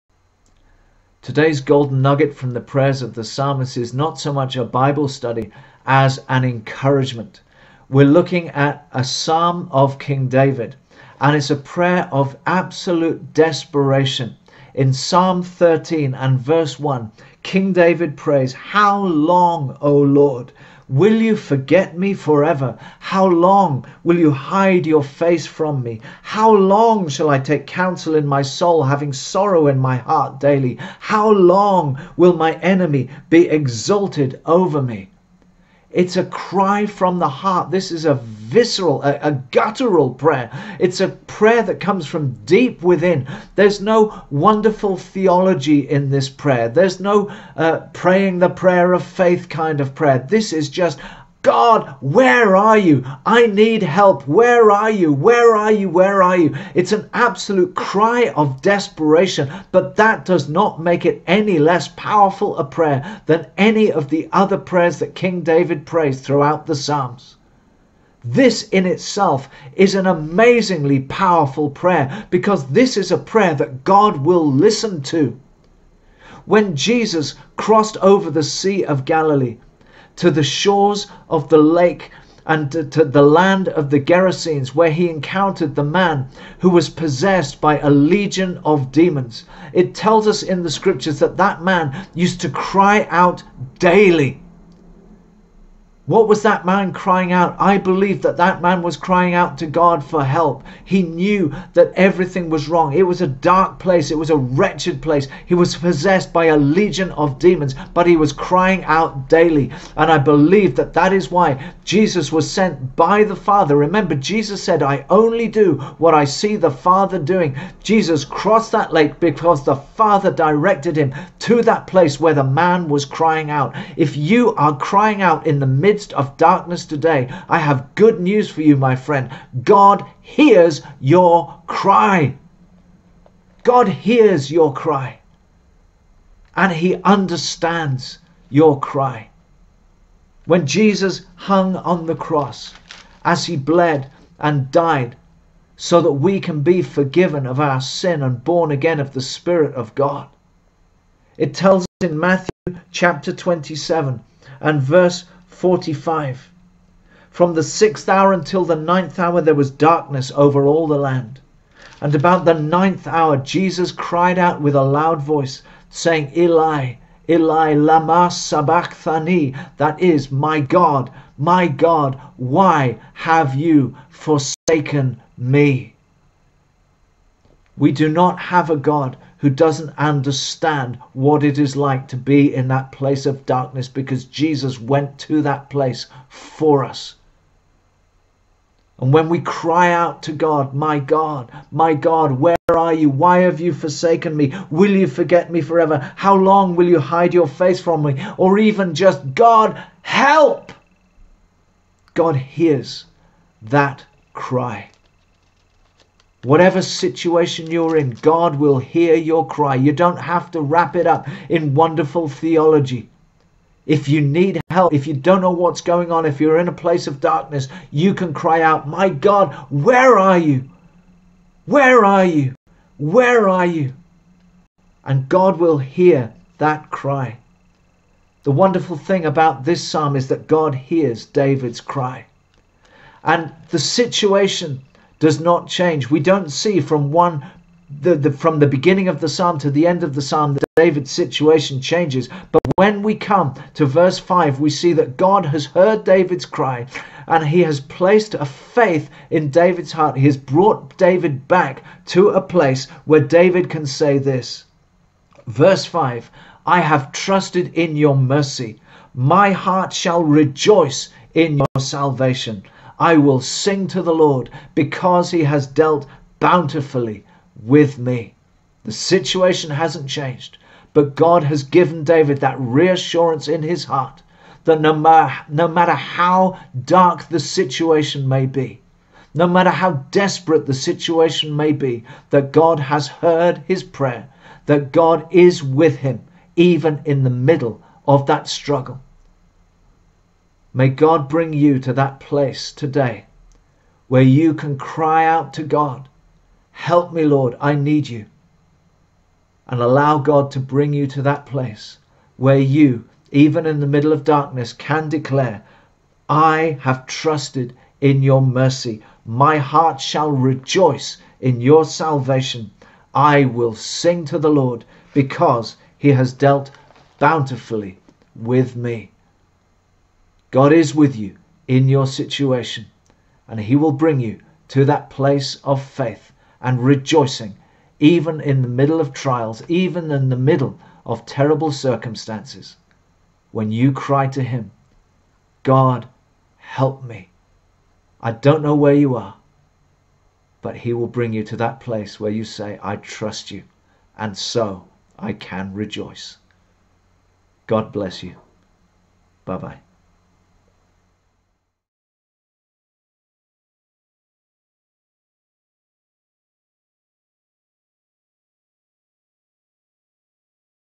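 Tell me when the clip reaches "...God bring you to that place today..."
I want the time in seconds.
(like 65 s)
290 s.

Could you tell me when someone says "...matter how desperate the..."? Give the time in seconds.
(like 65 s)
279 s.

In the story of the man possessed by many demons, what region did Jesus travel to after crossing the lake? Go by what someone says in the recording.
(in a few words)
the land of the Gerasenes.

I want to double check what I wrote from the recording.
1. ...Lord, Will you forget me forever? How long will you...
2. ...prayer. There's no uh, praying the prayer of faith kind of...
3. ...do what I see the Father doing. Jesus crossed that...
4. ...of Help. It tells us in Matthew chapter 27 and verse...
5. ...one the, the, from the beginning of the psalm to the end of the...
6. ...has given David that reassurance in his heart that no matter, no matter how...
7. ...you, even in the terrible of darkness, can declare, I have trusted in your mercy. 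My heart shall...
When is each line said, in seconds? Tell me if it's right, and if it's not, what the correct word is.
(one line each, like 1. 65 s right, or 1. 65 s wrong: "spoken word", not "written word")
1. 19 s right
2. 46 s right
3. 115 s right
4. 149 s wrong: "God", not "Help"
5. 237 s right
6. 271 s right
7. 302 s wrong: "middle", not "terrible".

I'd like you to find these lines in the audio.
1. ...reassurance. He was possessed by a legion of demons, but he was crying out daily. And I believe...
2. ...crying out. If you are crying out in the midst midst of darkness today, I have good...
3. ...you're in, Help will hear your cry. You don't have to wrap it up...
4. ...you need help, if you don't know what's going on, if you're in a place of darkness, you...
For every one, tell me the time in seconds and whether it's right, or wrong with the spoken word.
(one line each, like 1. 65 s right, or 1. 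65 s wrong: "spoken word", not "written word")
1. 105 s wrong: "place", not "reassurance"
2. 123 s right
3. 207 s wrong: "God", not "Help"
4. 214 s right.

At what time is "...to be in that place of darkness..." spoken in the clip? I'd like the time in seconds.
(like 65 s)
182 s.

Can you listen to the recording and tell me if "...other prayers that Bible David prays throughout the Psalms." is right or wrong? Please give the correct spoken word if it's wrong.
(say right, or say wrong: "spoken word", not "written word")
wrong: "King", not "Bible".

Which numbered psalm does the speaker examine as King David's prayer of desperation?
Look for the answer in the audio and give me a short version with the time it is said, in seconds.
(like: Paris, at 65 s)
Psalm 13, at 14 s.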